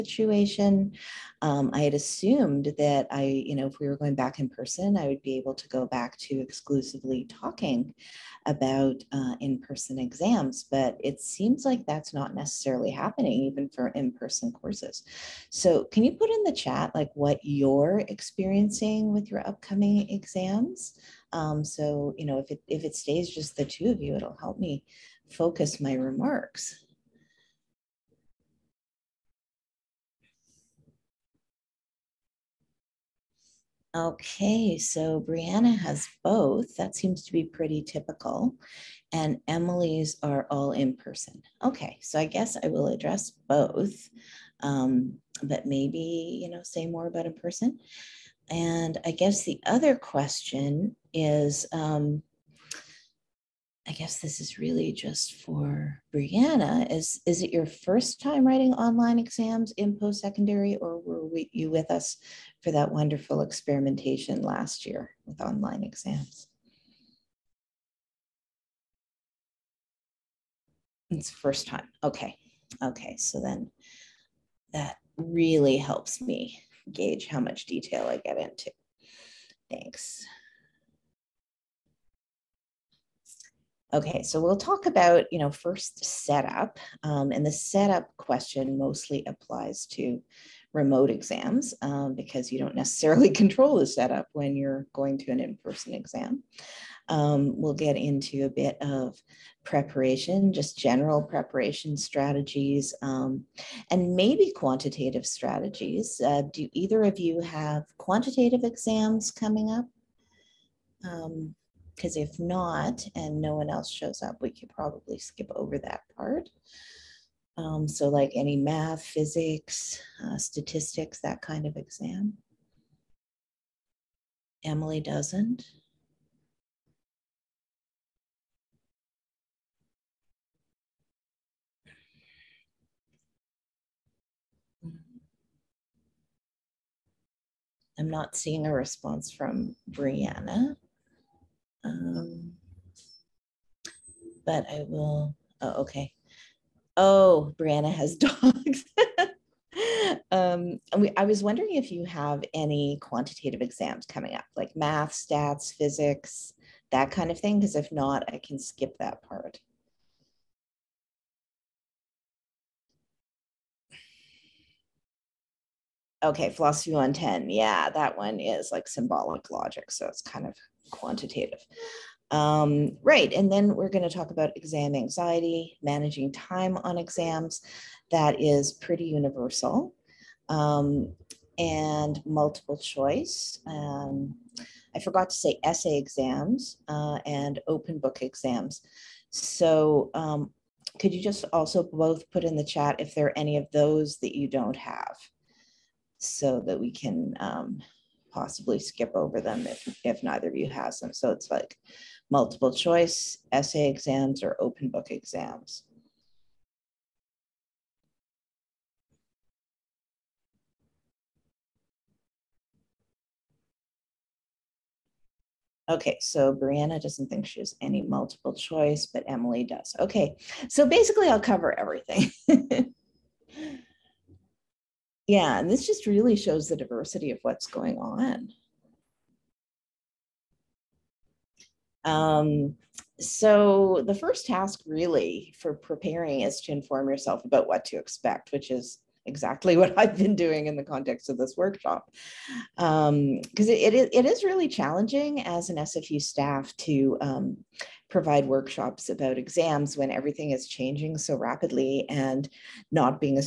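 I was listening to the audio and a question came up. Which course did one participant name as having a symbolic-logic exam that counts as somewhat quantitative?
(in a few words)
Philosophy 110.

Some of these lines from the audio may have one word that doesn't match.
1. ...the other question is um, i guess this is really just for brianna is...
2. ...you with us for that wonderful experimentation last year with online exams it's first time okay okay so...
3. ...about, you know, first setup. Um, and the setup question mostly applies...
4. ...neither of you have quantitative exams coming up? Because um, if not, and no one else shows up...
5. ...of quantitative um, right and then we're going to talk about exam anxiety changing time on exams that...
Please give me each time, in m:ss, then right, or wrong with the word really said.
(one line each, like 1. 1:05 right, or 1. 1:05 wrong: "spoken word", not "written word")
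1. 0:49 right
2. 1:01 right
3. 1:24 right
4. 1:46 wrong: "either", not "neither"
5. 2:50 wrong: "managing", not "changing".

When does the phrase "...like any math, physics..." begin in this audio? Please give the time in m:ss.
1:58.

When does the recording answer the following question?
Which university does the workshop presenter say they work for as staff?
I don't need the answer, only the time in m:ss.
4:05.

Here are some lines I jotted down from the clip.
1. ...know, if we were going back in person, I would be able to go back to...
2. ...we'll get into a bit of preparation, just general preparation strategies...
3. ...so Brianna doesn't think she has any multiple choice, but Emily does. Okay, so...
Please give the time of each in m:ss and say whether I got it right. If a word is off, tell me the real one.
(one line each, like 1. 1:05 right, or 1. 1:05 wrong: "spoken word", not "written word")
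1. 0:03 right
2. 1:37 right
3. 3:36 right.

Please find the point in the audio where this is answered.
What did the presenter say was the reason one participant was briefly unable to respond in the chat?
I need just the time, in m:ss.
2:28.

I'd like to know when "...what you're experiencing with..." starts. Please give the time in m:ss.
0:17.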